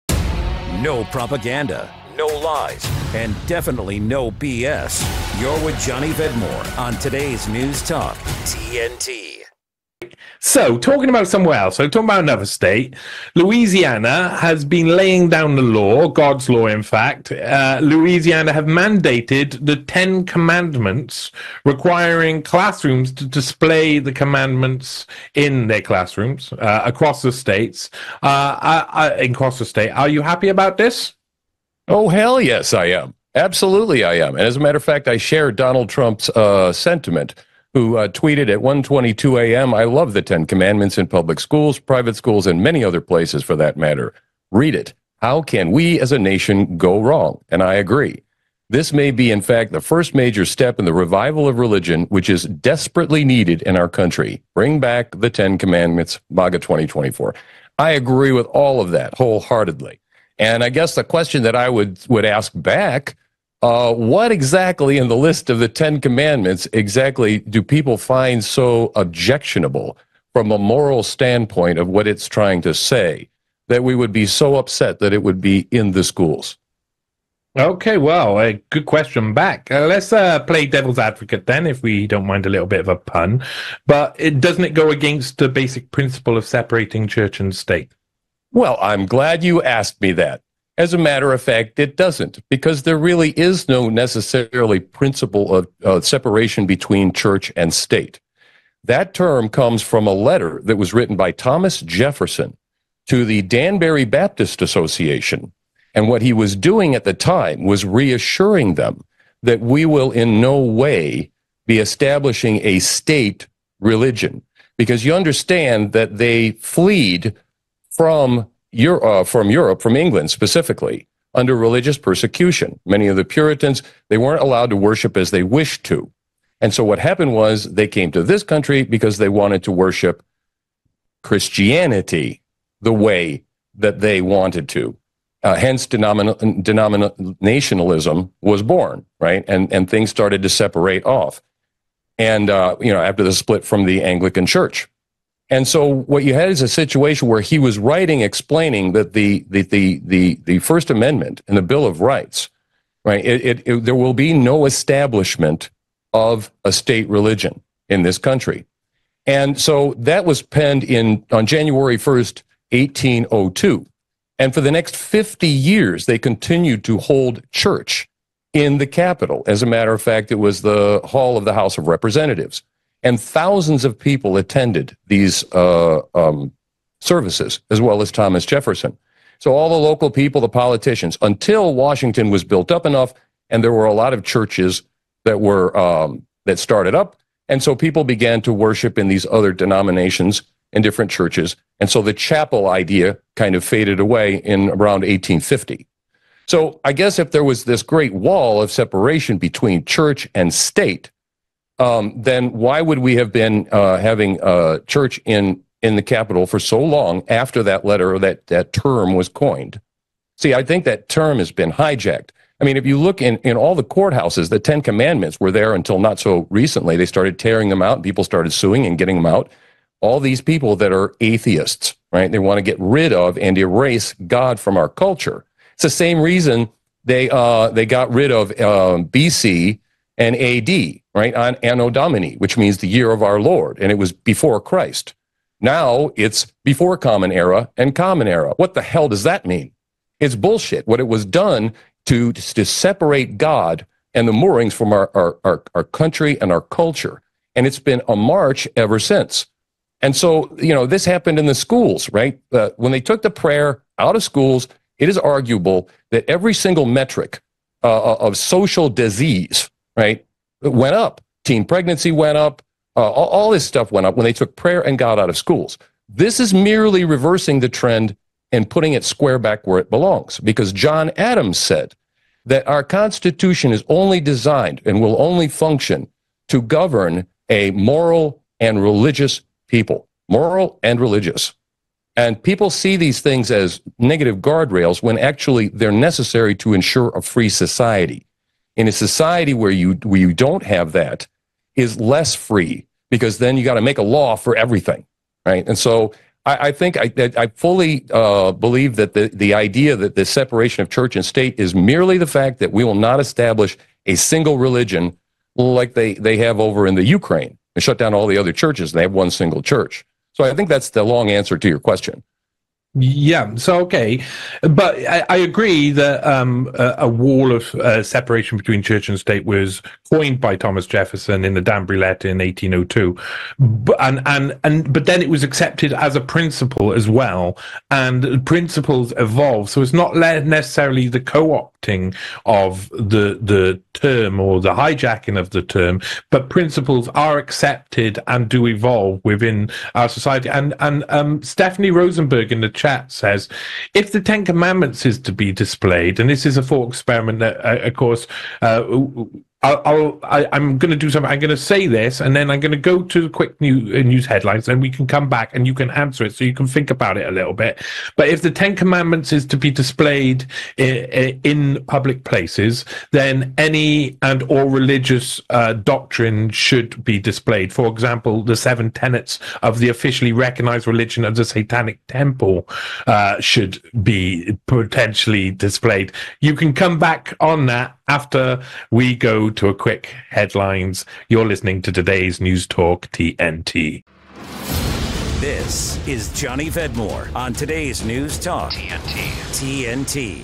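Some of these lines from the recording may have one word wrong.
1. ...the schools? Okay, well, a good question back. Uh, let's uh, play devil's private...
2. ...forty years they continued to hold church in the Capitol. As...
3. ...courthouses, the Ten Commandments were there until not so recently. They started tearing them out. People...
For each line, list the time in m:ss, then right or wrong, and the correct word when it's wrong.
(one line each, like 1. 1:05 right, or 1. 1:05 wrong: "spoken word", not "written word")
1. 1:15 wrong: "advocate", not "private"
2. 2:44 wrong: "fifty", not "forty"
3. 3:33 right.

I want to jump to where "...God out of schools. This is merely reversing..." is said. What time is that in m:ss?
4:24.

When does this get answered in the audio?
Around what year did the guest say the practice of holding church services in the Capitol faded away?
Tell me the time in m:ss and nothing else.
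3:15.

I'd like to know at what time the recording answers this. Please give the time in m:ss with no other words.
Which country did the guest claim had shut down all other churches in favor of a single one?
5:07.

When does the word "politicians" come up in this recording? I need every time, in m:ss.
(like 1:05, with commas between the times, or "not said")
3:00.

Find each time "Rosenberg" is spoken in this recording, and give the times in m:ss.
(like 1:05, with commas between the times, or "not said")
5:41.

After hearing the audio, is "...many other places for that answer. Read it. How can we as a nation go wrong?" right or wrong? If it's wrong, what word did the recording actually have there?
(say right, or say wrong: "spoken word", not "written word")
wrong: "matter", not "answer".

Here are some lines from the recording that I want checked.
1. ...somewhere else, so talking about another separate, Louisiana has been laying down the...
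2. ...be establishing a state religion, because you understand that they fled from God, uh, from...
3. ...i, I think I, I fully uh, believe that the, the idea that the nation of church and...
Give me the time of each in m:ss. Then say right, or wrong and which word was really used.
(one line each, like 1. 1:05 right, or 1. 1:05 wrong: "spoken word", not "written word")
1. 0:11 wrong: "state", not "separate"
2. 1:51 wrong: "Euro", not "God"
3. 4:56 wrong: "separation", not "nation".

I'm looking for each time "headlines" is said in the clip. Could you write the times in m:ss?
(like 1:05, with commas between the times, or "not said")
5:54, 6:20.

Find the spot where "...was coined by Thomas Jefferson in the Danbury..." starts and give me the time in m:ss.
5:19.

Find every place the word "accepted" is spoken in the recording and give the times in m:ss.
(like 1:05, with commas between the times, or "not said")
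5:25, 5:37.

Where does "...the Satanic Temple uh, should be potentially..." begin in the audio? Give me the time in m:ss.
6:11.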